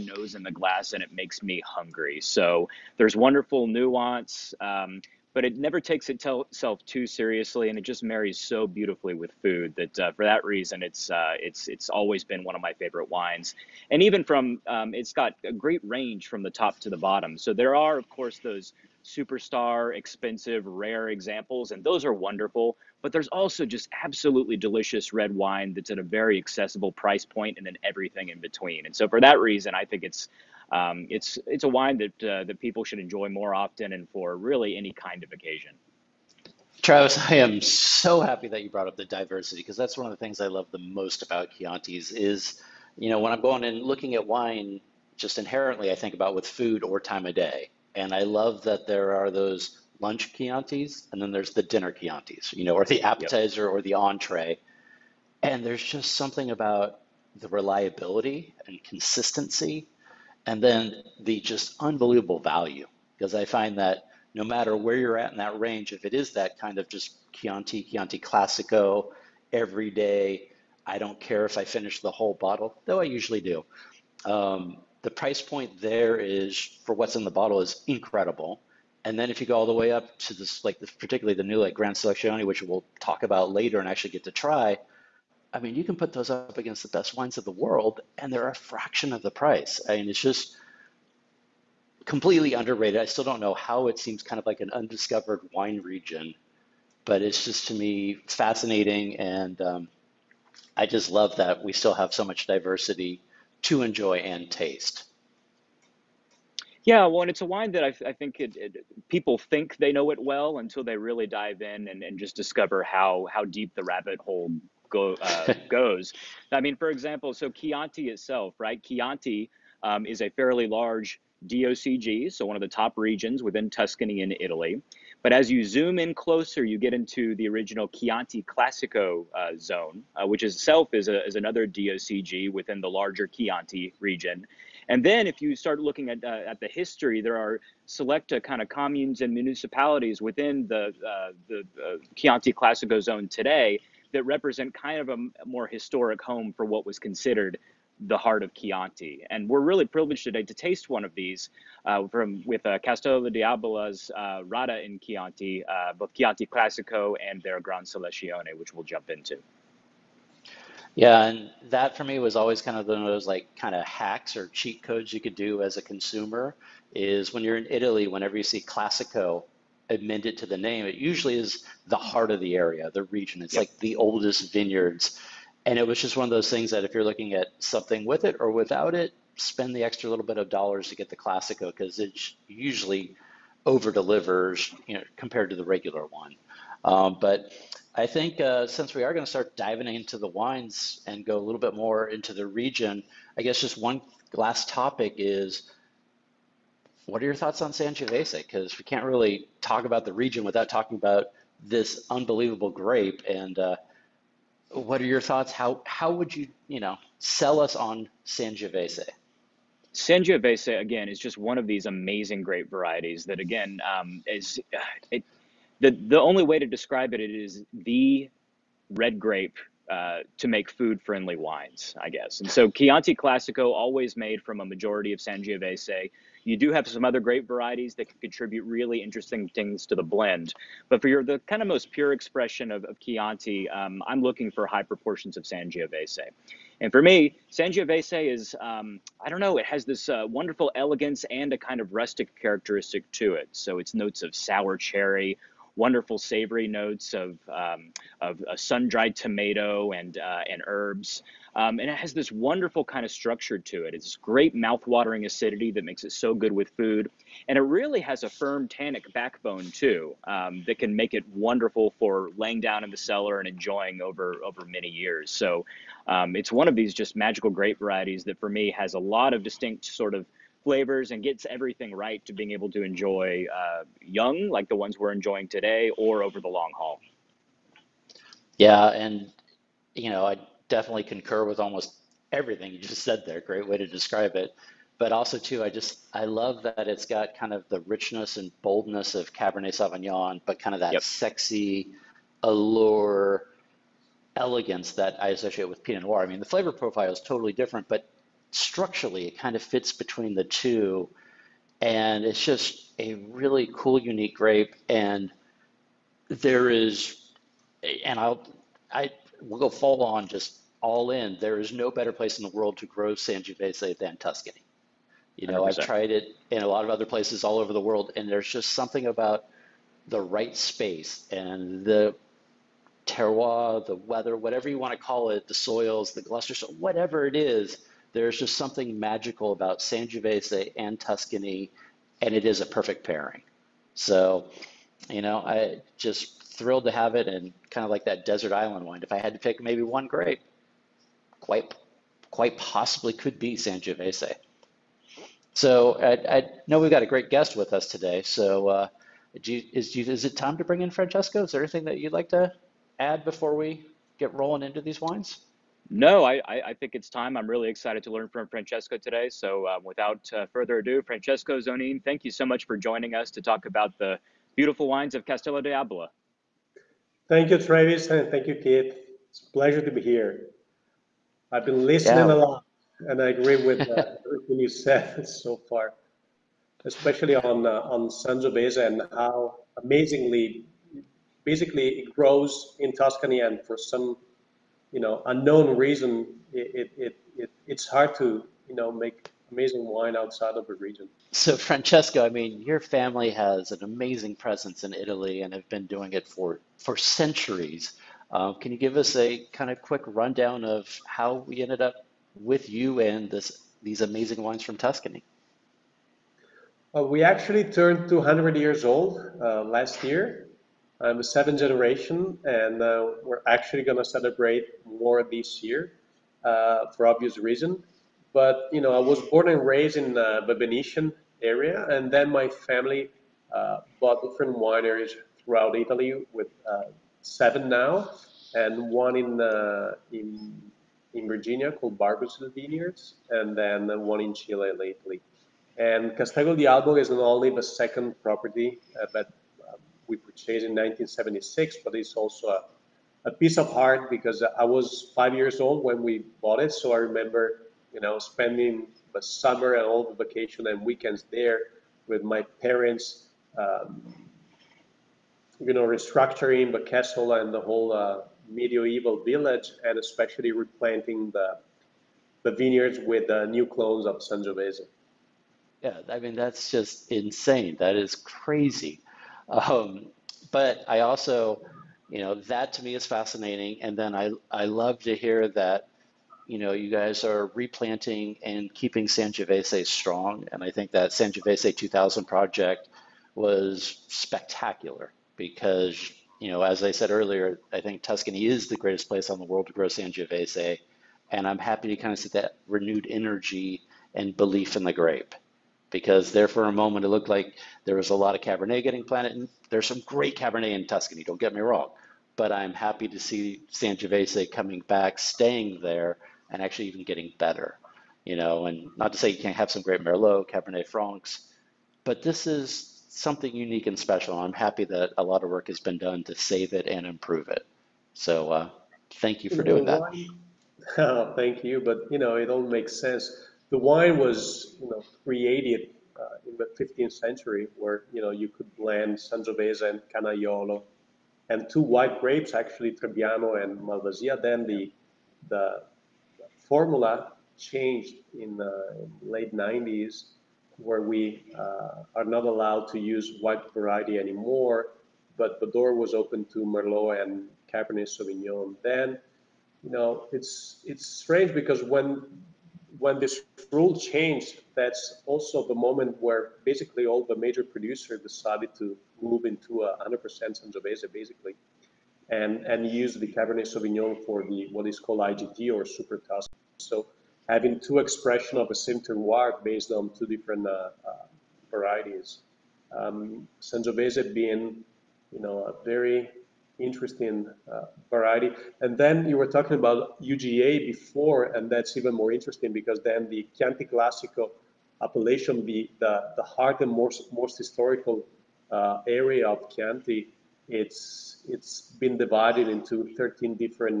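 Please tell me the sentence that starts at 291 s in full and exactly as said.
sexy allure elegance that I associate with Pinot Noir.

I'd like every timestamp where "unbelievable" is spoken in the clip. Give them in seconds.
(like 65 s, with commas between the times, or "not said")
61 s, 202 s.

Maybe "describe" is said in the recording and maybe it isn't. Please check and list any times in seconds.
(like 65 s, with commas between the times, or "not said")
216 s, 283 s.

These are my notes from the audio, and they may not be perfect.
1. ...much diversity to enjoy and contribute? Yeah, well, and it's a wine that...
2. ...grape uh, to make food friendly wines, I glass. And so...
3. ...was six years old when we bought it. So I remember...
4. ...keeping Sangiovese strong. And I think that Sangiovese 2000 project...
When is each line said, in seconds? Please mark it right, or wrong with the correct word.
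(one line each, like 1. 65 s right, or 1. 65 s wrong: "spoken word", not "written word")
1. 102 s wrong: "taste", not "contribute"
2. 219 s wrong: "guess", not "glass"
3. 444 s wrong: "five", not "six"
4. 478 s right.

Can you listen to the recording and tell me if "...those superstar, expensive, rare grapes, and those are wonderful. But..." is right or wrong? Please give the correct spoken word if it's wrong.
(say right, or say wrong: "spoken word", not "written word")
wrong: "examples", not "grapes".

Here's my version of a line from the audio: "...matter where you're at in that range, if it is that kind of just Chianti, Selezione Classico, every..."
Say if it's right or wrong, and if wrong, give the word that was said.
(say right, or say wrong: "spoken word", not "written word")
wrong: "Chianti", not "Selezione".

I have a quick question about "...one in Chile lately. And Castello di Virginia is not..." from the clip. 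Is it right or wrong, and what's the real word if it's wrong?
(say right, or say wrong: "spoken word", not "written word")
wrong: "Albo", not "Virginia".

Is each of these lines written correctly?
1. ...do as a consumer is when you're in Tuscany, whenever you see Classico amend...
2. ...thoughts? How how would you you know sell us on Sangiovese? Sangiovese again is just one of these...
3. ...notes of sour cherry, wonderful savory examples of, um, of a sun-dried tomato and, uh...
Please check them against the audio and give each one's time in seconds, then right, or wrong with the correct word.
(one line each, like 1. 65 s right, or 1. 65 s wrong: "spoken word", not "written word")
1. 165 s wrong: "Italy", not "Tuscany"
2. 205 s right
3. 243 s wrong: "notes", not "examples".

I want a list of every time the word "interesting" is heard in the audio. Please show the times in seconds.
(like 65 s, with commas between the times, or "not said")
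229 s, 576 s, 582 s.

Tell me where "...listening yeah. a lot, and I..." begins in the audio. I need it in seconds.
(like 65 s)
371 s.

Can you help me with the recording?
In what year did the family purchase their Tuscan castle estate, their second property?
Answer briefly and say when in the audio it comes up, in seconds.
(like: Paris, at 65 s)
1976, at 440 s.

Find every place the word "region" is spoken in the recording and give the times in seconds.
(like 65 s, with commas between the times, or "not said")
95 s, 122 s, 133 s, 173 s, 192 s, 200 s, 390 s.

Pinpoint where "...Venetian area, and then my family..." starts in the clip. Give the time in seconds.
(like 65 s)
420 s.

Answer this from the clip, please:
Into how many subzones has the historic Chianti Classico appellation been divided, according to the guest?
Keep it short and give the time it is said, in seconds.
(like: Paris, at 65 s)
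13, at 593 s.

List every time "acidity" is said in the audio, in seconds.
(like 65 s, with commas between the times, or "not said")
255 s.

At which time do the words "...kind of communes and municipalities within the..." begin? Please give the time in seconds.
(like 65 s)
138 s.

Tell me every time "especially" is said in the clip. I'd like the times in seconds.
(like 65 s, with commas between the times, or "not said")
376 s, 459 s.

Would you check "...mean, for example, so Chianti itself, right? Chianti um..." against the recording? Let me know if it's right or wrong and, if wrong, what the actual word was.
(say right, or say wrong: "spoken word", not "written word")
right.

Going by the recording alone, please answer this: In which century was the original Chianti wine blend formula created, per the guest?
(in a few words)
15th century.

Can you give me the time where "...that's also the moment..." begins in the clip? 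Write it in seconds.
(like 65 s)
554 s.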